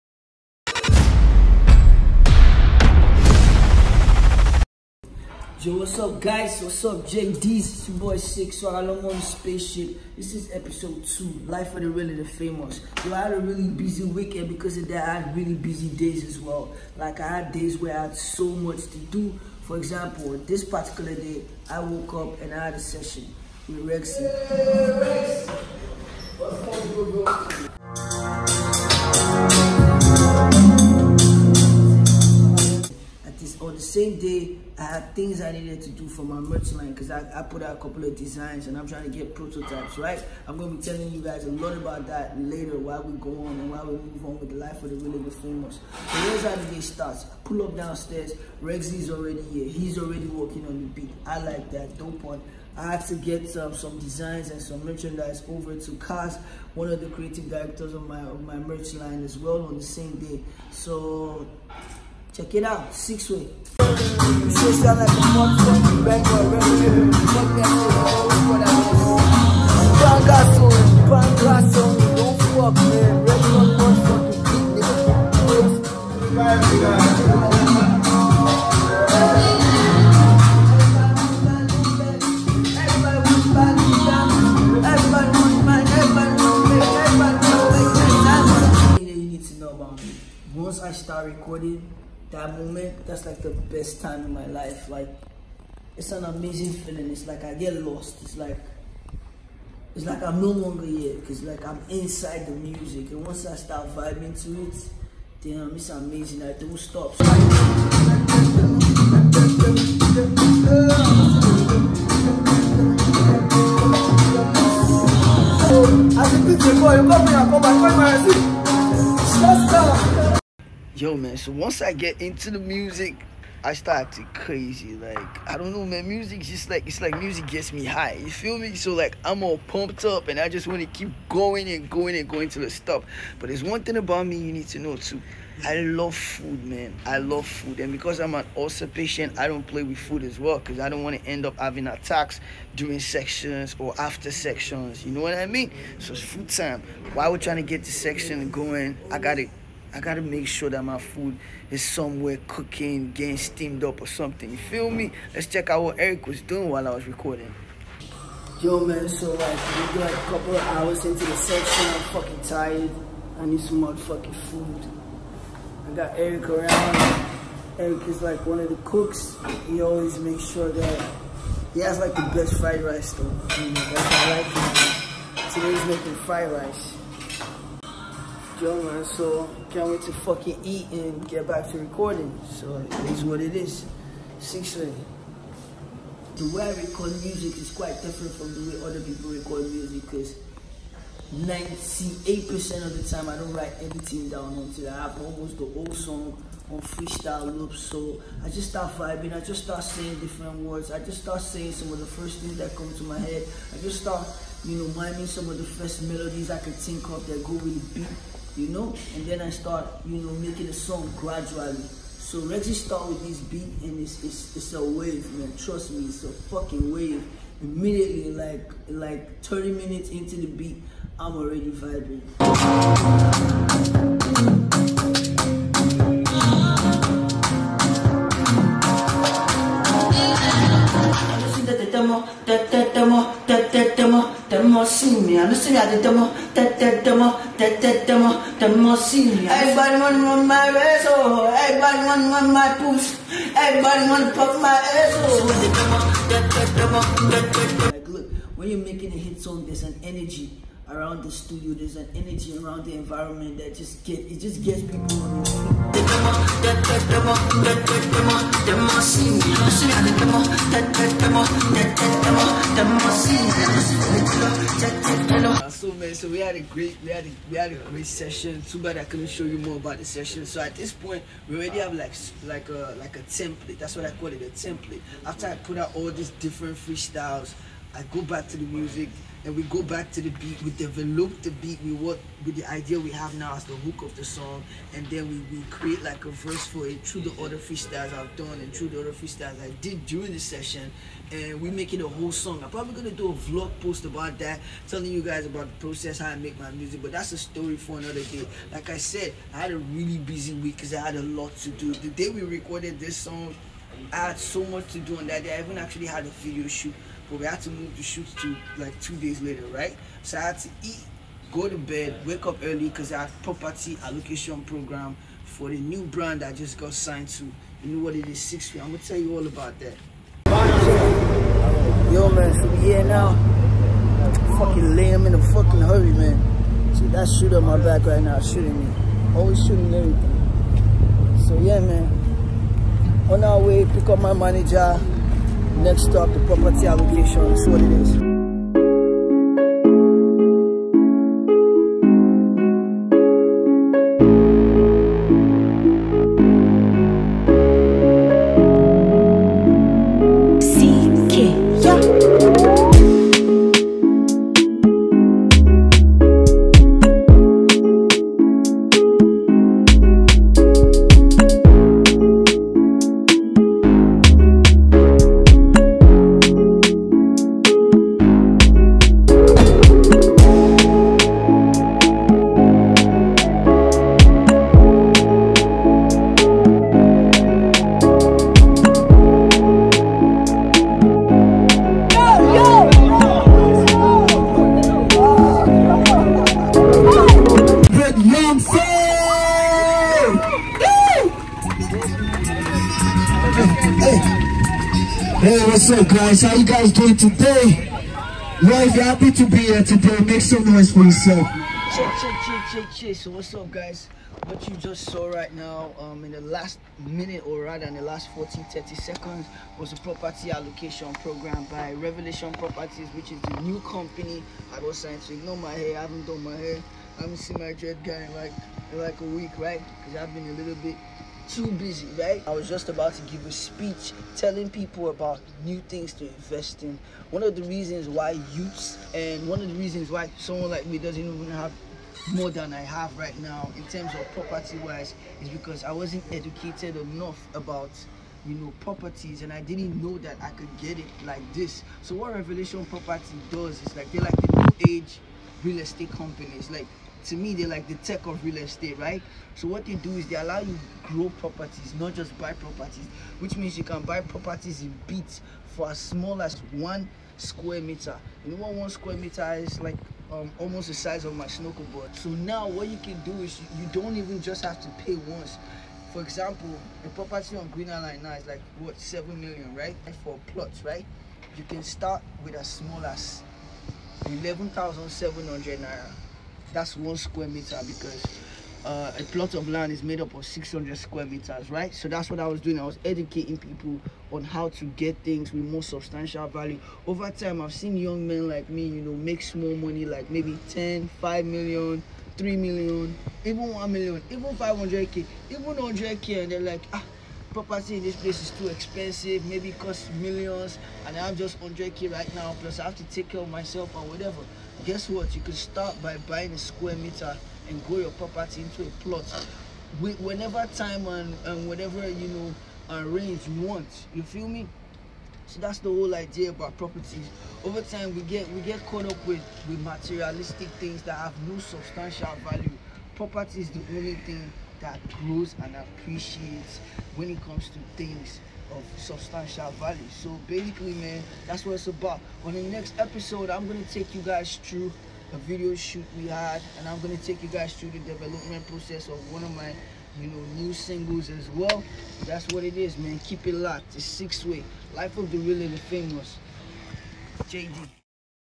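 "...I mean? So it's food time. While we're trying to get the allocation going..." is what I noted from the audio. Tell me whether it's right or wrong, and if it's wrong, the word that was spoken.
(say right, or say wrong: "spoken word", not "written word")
wrong: "section", not "allocation".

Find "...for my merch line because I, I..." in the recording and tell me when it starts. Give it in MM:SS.
00:36.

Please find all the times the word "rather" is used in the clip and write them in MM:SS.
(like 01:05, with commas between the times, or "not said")
06:47.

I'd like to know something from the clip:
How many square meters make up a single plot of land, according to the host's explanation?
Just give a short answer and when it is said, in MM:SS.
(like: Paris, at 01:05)
600, at 08:00.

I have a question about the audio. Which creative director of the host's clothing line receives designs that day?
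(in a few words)
Cass.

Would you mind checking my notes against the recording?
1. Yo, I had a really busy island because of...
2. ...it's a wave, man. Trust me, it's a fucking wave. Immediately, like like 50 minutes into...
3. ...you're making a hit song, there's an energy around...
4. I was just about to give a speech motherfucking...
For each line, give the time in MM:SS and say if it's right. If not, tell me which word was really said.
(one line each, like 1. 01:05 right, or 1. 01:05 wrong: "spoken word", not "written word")
1. 00:13 wrong: "weekend", not "island"
2. 03:34 wrong: "30", not "50"
3. 04:08 right
4. 07:02 wrong: "telling", not "motherfucking".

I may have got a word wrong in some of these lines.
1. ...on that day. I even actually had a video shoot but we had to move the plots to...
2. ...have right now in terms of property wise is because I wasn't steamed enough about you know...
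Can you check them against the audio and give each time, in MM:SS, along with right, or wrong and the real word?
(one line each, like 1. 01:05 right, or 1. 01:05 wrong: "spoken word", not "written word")
1. 05:05 wrong: "shoots", not "plots"
2. 07:12 wrong: "educated", not "steamed".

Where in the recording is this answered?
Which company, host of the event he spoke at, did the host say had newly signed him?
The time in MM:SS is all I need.
06:51.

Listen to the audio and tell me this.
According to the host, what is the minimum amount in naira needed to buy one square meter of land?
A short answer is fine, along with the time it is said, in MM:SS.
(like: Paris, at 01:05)
11,700 naira, at 07:54.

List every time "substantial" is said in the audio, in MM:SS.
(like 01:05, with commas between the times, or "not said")
08:05, 08:41, 08:48.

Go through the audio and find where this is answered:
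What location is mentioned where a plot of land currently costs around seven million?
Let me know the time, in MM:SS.
07:47.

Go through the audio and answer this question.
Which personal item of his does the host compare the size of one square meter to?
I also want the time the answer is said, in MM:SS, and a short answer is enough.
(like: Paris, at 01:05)
Snorkel board, at 07:41.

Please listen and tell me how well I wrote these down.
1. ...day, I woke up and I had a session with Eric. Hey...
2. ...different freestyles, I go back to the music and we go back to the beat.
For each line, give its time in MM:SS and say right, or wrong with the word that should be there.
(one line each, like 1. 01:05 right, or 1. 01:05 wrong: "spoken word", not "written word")
1. 00:21 wrong: "Rexxie", not "Eric"
2. 04:36 right.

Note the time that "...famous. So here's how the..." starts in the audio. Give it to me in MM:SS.
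00:45.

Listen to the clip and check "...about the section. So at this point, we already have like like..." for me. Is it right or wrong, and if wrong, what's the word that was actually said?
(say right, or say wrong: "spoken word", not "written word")
wrong: "session", not "section".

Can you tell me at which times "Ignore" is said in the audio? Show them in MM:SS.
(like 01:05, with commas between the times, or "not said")
06:55.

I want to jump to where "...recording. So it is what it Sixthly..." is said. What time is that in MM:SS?
03:01.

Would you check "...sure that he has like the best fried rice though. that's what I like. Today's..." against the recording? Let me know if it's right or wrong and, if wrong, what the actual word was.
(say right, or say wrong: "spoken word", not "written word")
right.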